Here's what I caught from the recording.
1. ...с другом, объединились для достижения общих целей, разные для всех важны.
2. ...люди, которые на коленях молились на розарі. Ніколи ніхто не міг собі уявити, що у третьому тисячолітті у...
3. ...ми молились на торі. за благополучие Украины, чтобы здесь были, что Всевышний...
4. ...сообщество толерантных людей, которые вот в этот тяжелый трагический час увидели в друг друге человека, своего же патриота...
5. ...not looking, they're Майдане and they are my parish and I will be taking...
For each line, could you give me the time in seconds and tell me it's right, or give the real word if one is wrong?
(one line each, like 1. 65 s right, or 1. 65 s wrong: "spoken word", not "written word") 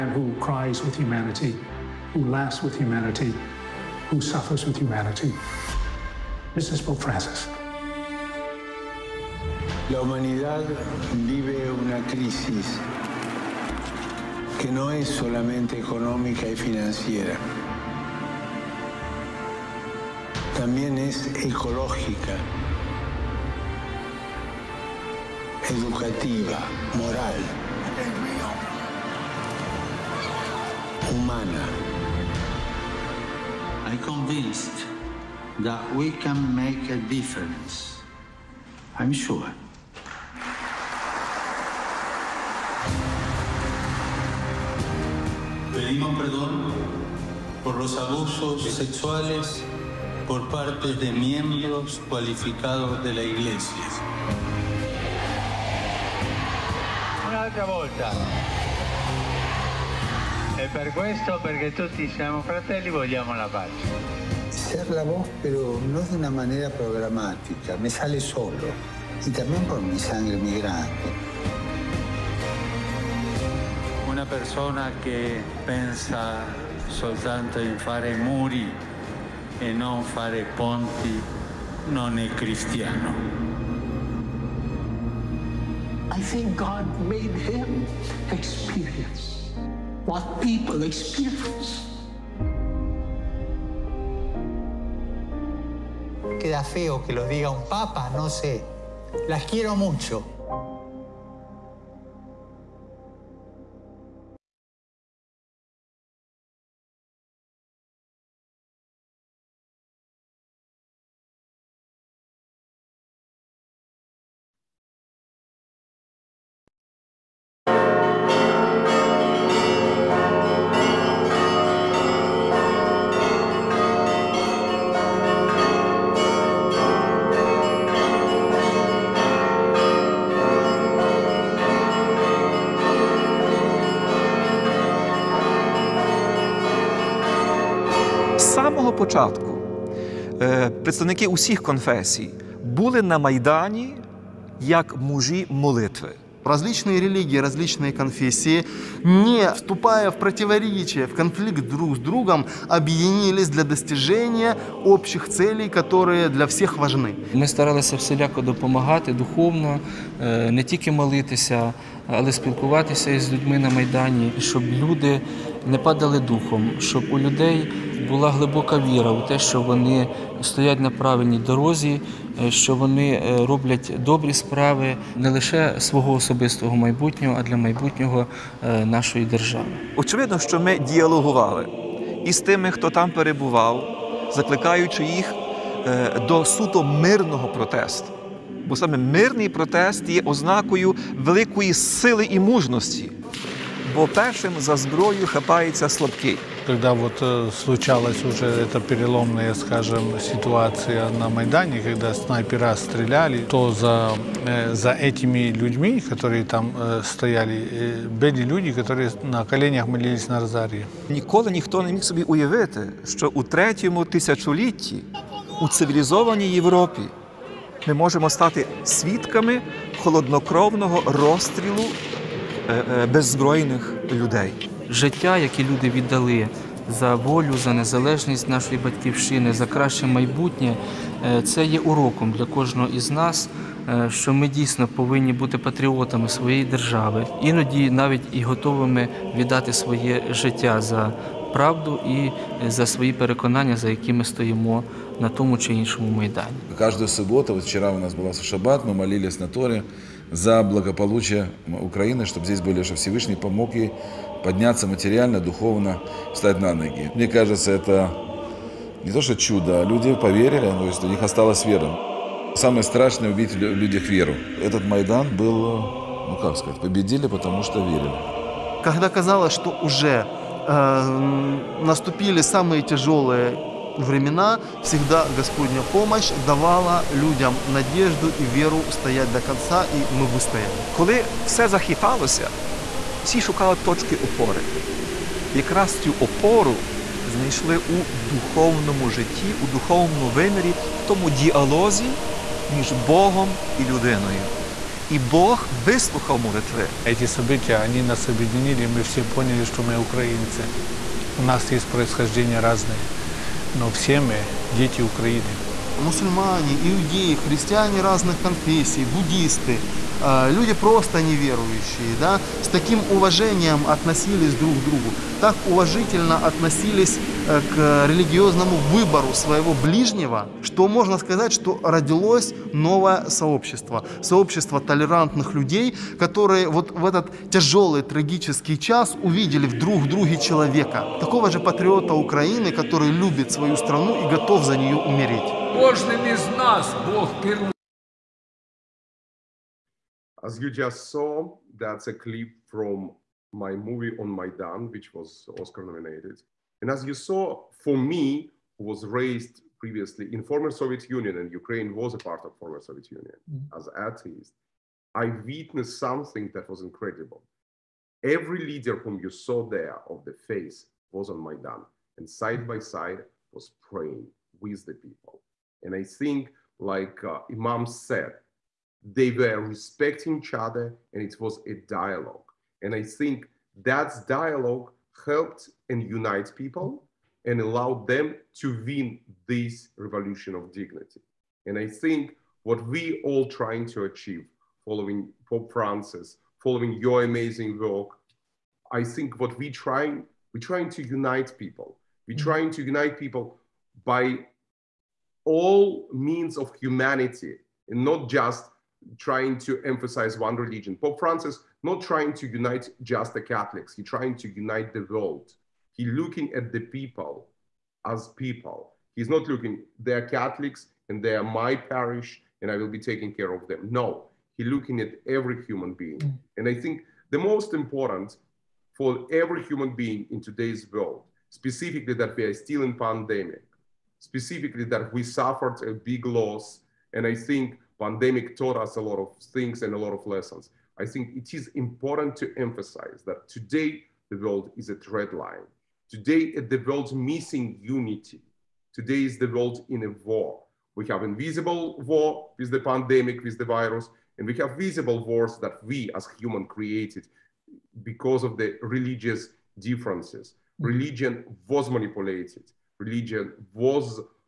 1. 151 s wrong: "которые", not "разные"
2. 208 s right
3. 248 s right
4. 324 s wrong: "такого", not "своего"
5. 409 s wrong: "Catholics", not "Майдане".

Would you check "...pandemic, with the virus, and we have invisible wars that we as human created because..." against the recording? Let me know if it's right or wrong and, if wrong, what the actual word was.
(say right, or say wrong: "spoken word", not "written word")
wrong: "visible", not "invisible".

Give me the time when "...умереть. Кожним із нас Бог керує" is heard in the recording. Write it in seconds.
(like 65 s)
334 s.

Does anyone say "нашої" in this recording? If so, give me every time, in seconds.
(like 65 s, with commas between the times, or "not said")
178 s, 228 s.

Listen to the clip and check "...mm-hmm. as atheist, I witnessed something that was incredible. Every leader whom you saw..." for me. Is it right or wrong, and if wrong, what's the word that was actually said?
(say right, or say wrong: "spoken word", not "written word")
right.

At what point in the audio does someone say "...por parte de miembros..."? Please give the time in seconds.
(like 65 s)
50 s.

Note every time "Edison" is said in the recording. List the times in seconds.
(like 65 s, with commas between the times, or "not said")
not said.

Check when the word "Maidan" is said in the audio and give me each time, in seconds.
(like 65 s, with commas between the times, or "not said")
344 s, 361 s.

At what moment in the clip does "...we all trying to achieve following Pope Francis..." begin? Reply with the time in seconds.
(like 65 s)
382 s.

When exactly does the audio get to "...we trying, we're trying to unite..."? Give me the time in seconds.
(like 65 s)
389 s.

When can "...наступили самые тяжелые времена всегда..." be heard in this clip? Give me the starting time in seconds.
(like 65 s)
271 s.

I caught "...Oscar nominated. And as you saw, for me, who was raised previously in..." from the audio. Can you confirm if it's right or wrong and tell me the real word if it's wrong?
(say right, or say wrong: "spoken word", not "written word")
right.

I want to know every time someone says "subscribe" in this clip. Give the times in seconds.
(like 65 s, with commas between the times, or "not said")
not said.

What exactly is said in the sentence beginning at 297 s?
Эти события, они нас объединили, мы все поняли, что мы украинцы.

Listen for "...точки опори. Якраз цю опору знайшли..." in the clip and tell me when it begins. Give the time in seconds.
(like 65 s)
283 s.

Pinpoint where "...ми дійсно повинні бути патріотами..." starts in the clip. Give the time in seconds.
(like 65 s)
234 s.